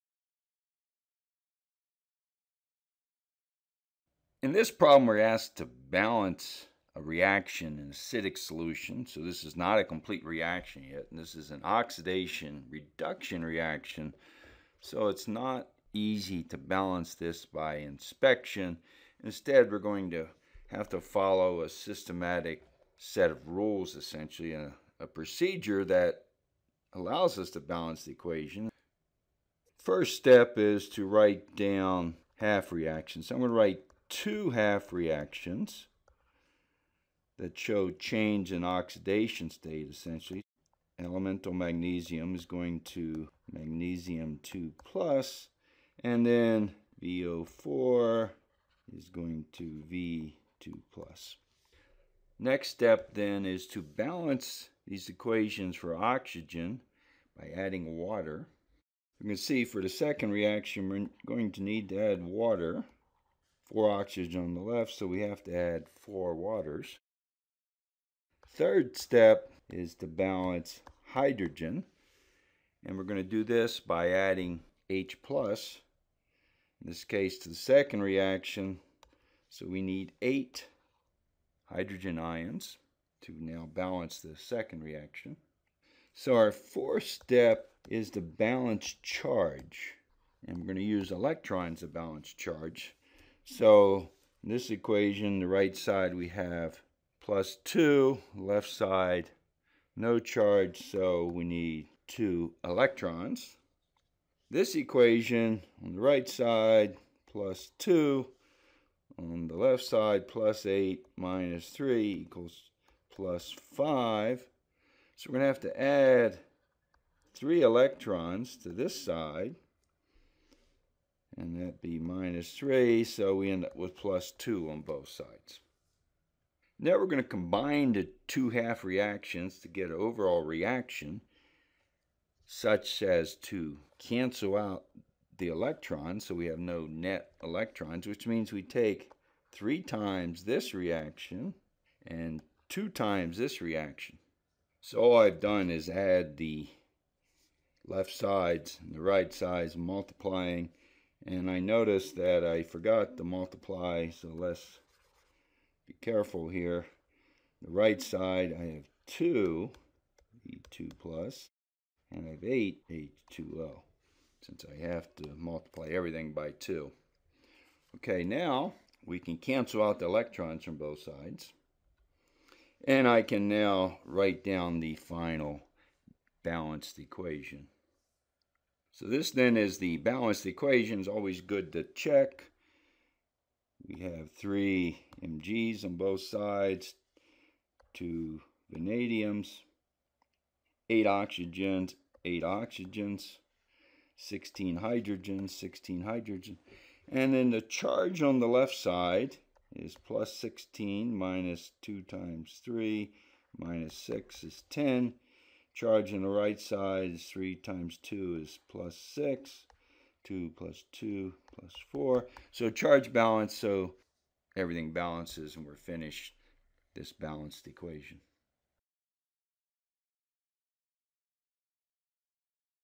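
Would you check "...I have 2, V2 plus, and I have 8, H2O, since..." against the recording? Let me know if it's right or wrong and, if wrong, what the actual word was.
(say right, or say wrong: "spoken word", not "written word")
right.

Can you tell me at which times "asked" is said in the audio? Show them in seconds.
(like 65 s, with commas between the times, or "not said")
5 s.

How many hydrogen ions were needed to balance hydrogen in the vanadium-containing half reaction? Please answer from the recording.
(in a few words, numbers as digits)
8.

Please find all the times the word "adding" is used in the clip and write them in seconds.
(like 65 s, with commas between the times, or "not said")
57 s, 74 s.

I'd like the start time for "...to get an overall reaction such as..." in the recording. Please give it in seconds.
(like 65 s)
129 s.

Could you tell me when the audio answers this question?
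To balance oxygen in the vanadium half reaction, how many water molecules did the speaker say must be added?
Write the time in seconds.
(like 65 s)
65 s.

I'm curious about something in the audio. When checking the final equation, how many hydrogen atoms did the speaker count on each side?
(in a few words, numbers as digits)
16.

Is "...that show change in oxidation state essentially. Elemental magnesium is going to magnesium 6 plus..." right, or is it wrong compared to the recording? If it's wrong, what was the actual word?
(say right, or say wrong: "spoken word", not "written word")
wrong: "2", not "6".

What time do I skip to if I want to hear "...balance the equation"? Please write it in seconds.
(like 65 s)
27 s.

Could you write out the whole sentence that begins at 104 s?
This equation on the right side plus 2, on the left side plus 8 minus 3 equals plus 5.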